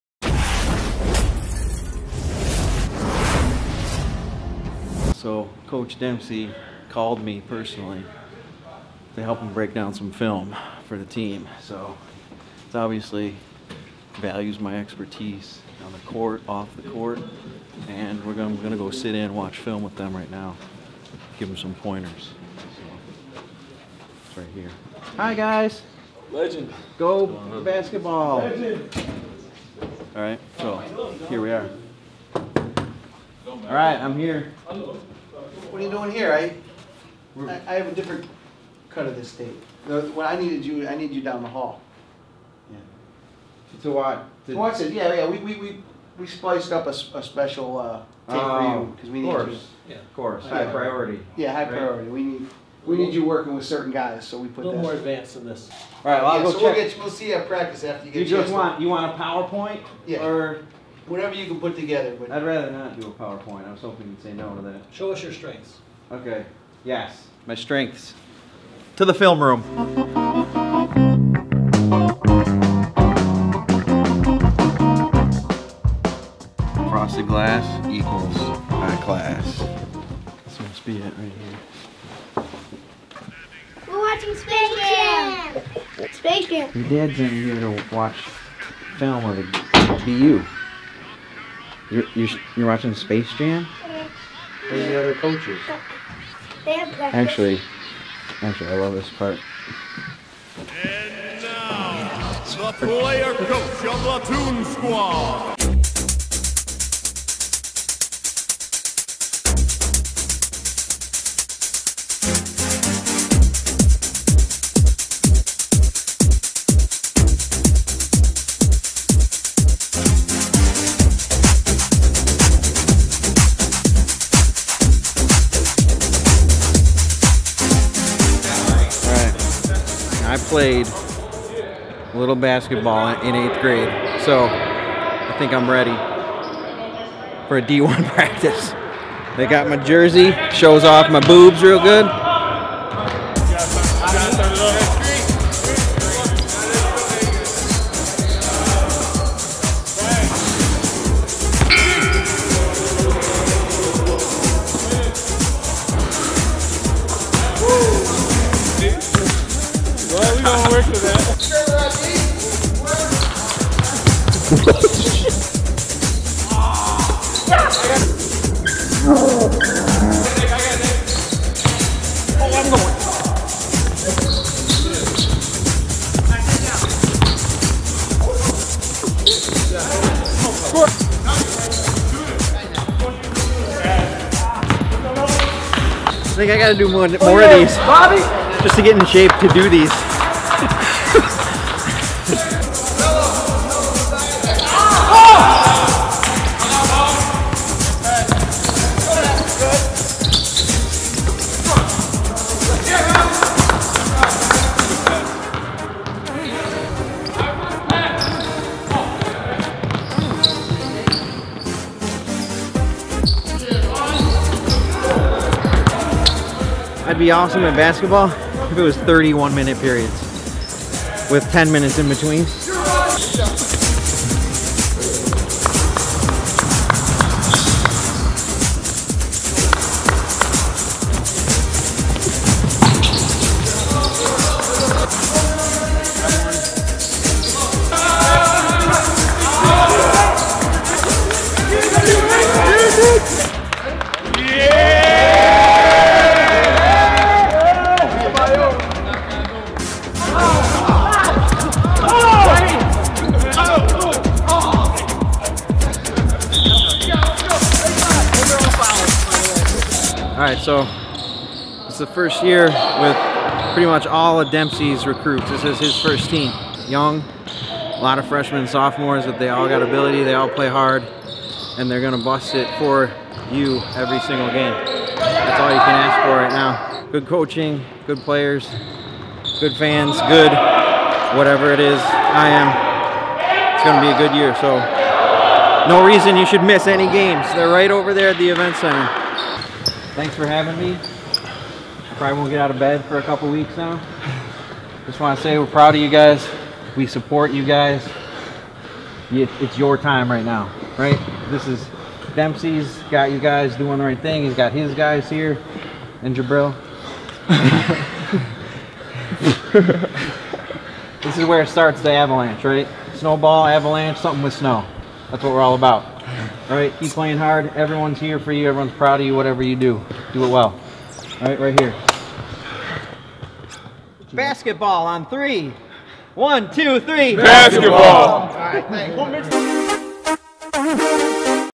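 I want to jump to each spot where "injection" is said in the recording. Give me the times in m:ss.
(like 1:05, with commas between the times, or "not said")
not said.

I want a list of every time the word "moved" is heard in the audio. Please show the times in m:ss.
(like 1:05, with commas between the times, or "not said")
not said.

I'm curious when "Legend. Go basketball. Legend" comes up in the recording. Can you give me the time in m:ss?
0:26.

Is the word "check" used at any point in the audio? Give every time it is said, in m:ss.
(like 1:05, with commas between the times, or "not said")
0:56.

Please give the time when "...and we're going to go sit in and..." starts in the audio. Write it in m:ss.
0:17.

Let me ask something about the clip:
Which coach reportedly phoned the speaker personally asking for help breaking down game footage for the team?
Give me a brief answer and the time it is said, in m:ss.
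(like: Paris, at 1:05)
Coach Dempsey, at 0:05.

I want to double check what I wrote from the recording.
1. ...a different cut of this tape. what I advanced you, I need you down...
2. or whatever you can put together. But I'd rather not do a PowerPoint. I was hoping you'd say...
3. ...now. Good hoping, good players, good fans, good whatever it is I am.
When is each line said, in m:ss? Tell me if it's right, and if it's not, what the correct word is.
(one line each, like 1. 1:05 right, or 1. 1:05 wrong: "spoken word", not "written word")
1. 0:37 wrong: "needed", not "advanced"
2. 1:00 right
3. 4:36 wrong: "coaching", not "hoping".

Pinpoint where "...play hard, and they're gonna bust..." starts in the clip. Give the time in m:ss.
4:30.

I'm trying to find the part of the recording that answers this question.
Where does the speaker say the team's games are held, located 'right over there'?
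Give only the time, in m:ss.
4:48.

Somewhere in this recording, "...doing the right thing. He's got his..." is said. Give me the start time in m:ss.
5:03.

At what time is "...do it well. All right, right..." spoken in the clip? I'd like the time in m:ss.
5:20.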